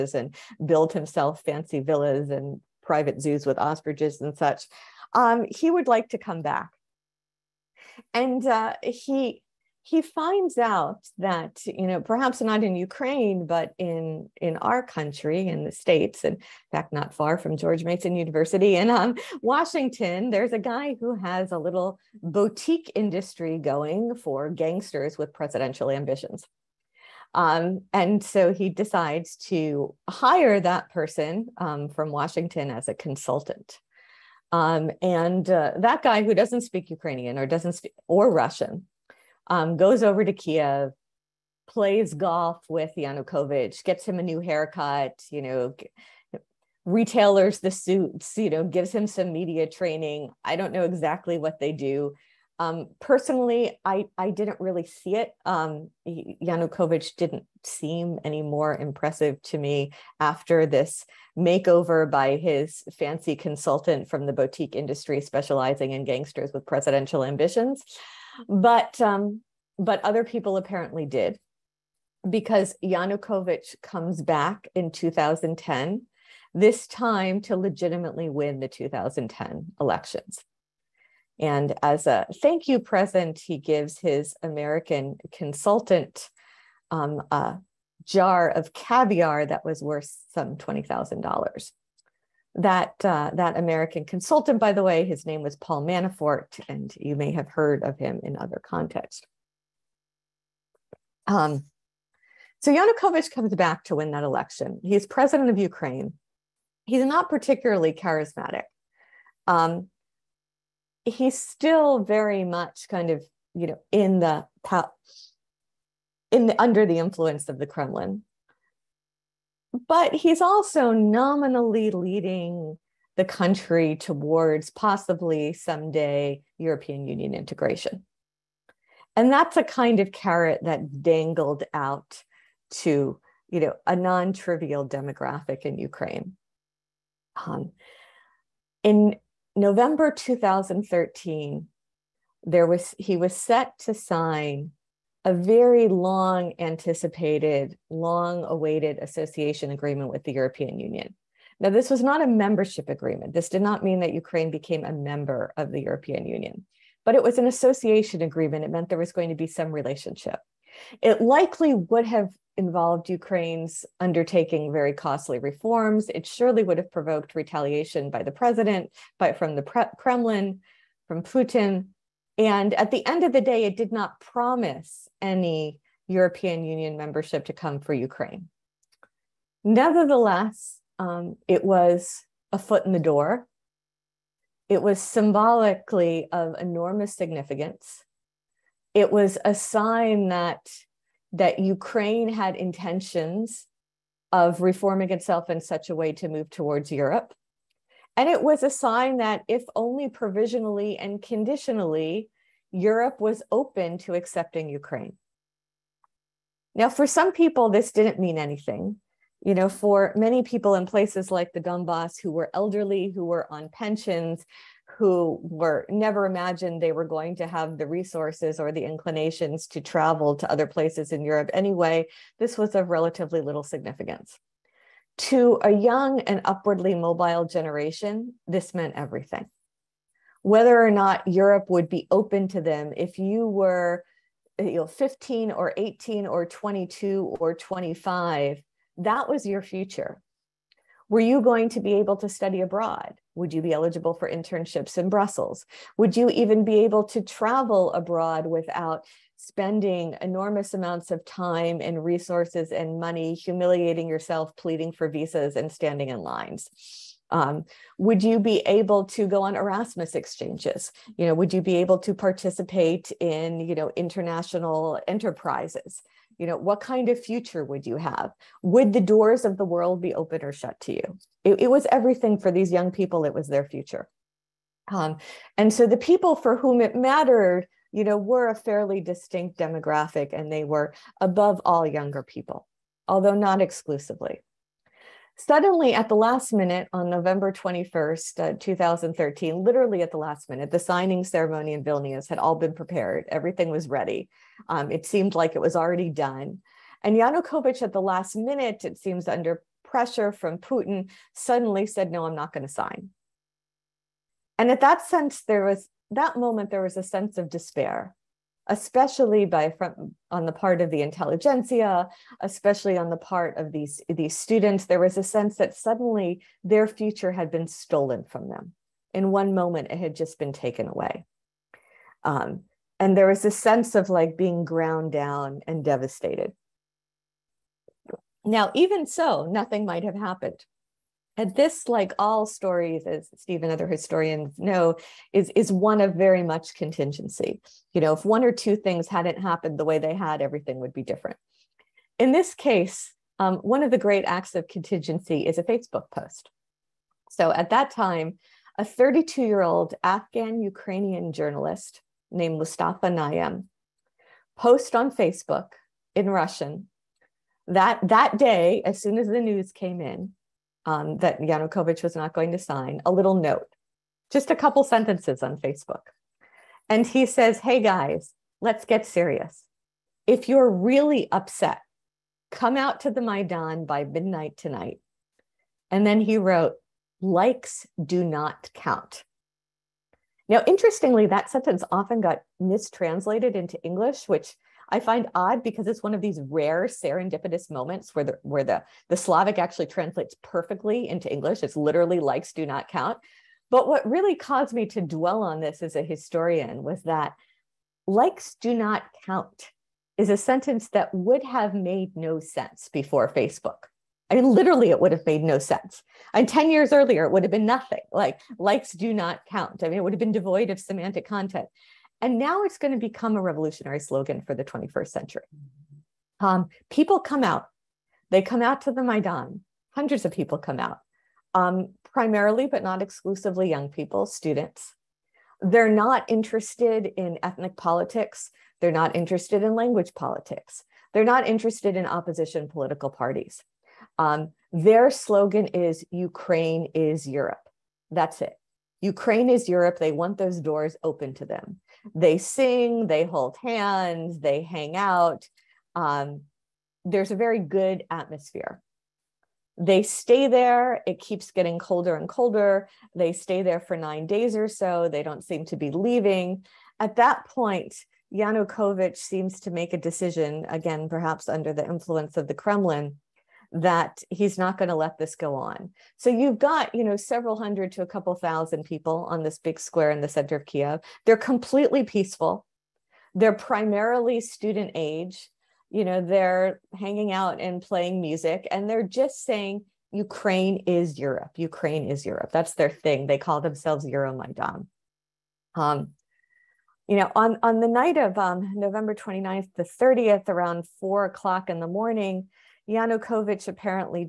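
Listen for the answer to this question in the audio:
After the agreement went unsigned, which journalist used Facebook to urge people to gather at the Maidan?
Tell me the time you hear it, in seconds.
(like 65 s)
352 s.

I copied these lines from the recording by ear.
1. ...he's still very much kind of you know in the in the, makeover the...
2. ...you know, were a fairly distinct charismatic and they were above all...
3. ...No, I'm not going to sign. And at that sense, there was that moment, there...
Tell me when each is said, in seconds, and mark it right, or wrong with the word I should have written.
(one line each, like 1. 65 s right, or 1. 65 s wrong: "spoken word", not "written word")
1. 111 s wrong: "under", not "makeover"
2. 277 s wrong: "demographic", not "charismatic"
3. 302 s right.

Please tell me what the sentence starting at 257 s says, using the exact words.
Um, would you be able to go on Erasmus exchanges?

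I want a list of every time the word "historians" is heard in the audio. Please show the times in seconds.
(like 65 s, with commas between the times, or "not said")
333 s, 396 s.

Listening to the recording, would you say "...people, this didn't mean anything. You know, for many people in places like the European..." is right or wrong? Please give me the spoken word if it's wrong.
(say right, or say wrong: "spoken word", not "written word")
wrong: "Donbass", not "European".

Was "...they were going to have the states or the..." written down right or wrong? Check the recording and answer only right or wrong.
wrong.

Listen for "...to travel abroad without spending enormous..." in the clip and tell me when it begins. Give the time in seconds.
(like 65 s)
247 s.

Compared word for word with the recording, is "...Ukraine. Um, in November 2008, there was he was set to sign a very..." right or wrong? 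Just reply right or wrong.
wrong.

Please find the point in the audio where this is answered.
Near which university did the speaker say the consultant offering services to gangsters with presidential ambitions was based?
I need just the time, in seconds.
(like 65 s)
17 s.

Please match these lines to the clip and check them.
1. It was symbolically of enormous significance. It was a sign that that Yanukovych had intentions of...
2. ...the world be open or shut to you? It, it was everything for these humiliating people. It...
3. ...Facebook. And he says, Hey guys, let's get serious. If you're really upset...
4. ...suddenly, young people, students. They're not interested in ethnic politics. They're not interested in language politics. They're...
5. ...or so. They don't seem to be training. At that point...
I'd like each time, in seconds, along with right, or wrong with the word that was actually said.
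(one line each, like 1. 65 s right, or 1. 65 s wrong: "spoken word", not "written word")
1. 184 s wrong: "Ukraine", not "Yanukovych"
2. 269 s wrong: "young", not "humiliating"
3. 365 s right
4. 423 s wrong: "exclusively", not "suddenly"
5. 454 s wrong: "leaving", not "training".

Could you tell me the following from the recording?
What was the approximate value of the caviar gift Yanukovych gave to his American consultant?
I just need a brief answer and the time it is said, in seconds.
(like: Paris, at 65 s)
$20,000, at 90 s.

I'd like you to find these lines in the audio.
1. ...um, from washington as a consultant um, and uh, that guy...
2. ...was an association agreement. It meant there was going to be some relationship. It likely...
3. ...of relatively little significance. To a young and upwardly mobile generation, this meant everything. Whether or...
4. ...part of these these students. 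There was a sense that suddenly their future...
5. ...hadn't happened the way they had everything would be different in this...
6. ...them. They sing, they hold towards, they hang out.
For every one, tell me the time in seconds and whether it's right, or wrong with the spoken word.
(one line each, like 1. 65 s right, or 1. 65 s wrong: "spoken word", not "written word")
1. 31 s right
2. 157 s right
3. 222 s right
4. 313 s right
5. 339 s right
6. 441 s wrong: "hands", not "towards".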